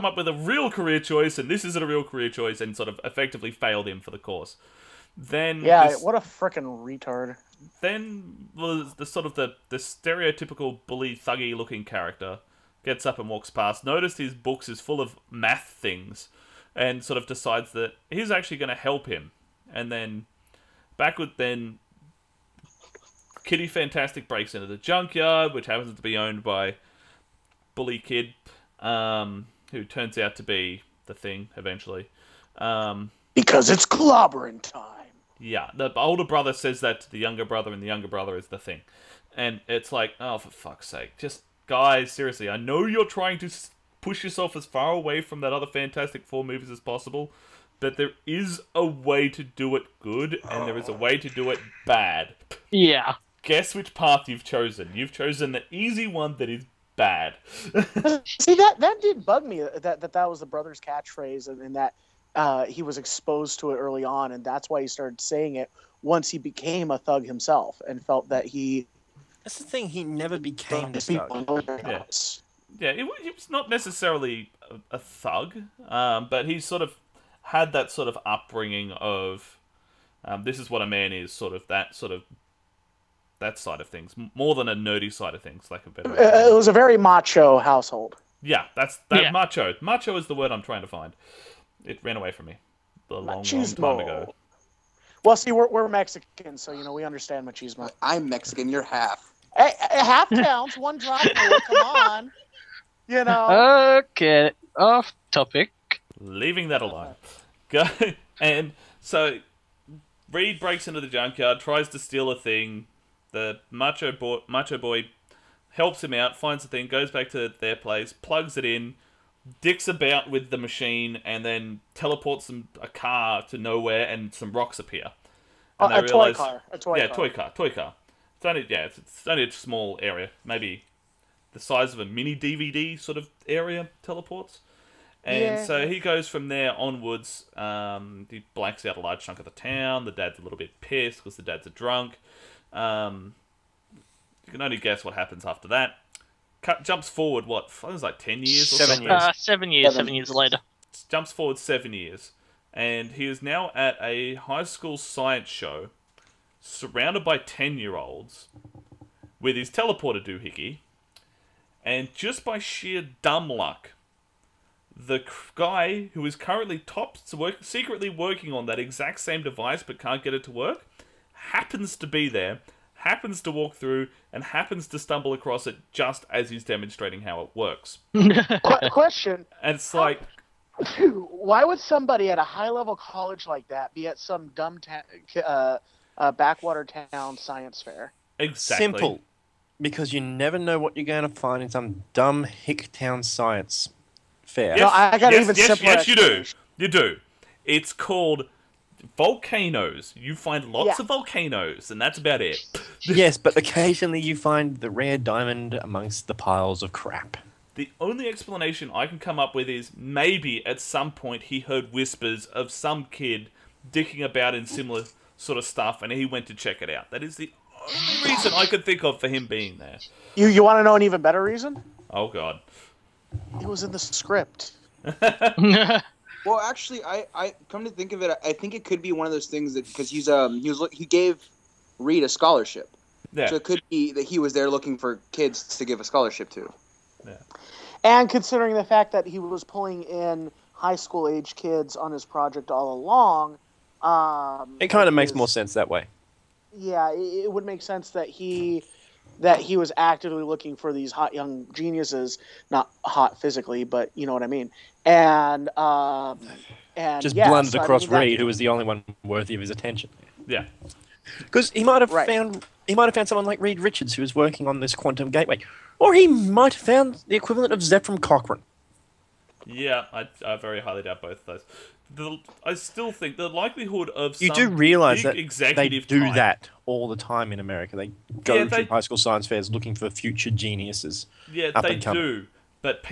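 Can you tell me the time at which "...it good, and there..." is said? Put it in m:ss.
0:49.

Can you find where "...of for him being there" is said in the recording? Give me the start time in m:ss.
3:39.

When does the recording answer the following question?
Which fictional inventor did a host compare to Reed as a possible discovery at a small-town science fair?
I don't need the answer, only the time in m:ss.
4:27.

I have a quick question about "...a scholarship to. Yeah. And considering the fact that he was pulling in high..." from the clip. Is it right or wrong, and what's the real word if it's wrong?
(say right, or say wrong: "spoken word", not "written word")
right.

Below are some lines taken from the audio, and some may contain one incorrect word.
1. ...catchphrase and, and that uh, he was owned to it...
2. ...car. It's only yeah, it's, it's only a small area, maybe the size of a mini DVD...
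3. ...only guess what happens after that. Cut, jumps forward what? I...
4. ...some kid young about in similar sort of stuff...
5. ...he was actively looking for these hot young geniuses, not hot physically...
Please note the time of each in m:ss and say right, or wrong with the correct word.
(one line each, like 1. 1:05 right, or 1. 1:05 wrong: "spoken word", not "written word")
1. 1:00 wrong: "exposed", not "owned"
2. 2:07 right
3. 2:24 right
4. 3:32 wrong: "dicking", not "young"
5. 4:09 right.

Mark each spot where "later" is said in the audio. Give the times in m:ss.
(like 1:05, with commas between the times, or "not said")
2:30.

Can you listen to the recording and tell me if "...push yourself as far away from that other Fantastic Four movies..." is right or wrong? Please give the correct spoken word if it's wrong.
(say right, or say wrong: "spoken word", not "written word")
right.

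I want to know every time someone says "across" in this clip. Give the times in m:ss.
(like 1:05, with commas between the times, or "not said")
2:55, 4:17.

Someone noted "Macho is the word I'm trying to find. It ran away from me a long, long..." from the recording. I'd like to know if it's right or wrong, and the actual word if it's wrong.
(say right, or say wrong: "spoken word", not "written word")
right.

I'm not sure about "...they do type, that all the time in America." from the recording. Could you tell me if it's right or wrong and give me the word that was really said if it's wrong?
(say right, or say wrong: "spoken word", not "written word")
right.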